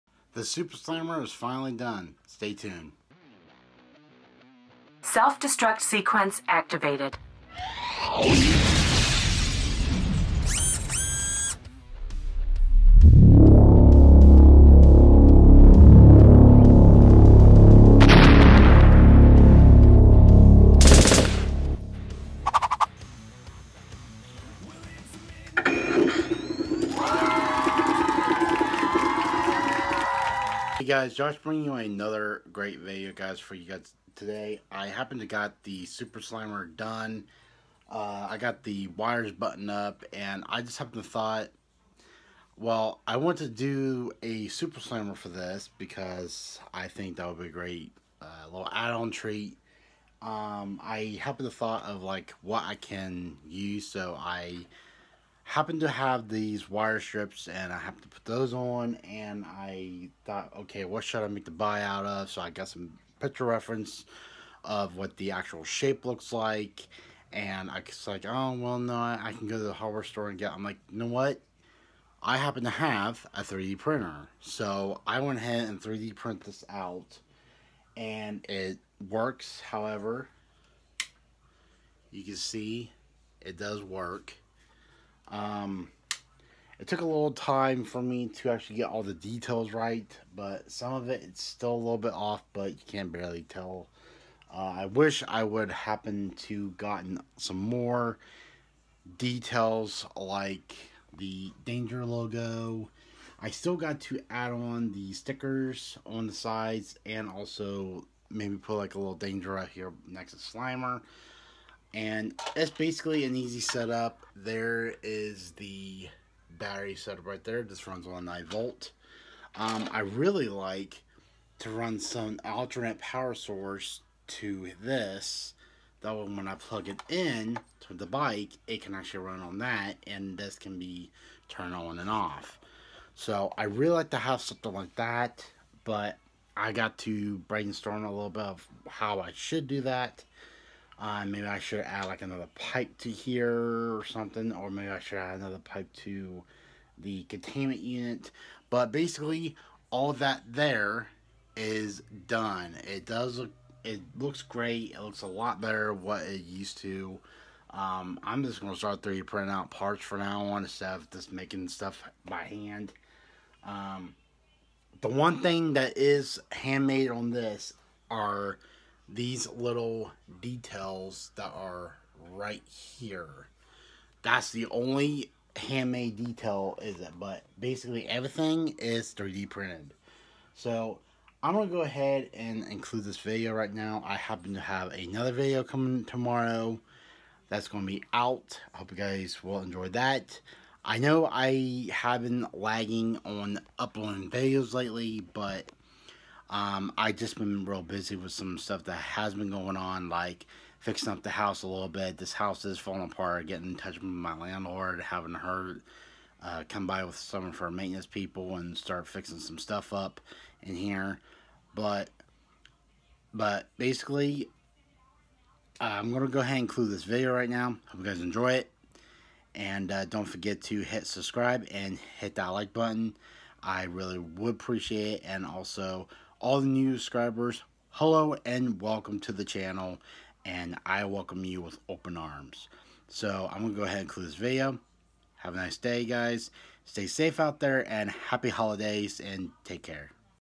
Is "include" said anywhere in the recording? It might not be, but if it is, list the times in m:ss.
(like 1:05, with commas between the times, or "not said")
3:02, 3:36.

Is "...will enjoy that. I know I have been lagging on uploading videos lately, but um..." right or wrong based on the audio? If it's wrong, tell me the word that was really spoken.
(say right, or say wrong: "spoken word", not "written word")
right.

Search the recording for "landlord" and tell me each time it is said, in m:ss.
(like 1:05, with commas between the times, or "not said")
3:24.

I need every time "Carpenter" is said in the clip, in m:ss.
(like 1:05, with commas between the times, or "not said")
not said.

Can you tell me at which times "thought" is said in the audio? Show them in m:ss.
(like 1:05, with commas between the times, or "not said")
0:41, 0:51, 1:00.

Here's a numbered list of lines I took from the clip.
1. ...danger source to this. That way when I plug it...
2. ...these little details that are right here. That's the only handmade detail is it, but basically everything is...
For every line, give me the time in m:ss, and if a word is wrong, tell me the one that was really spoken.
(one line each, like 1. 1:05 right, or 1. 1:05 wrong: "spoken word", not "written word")
1. 2:02 wrong: "power", not "danger"
2. 2:49 right.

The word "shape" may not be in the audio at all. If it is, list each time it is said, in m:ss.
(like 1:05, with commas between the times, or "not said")
1:05.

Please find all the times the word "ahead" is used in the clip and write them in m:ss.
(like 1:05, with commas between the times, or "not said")
1:15, 3:01, 3:36, 3:53.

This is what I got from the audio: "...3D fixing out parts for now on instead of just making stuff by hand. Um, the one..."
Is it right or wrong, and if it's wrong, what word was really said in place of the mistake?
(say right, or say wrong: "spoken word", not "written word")
wrong: "printing", not "fixing".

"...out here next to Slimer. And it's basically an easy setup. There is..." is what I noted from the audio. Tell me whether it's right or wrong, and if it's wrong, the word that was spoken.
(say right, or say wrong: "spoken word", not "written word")
right.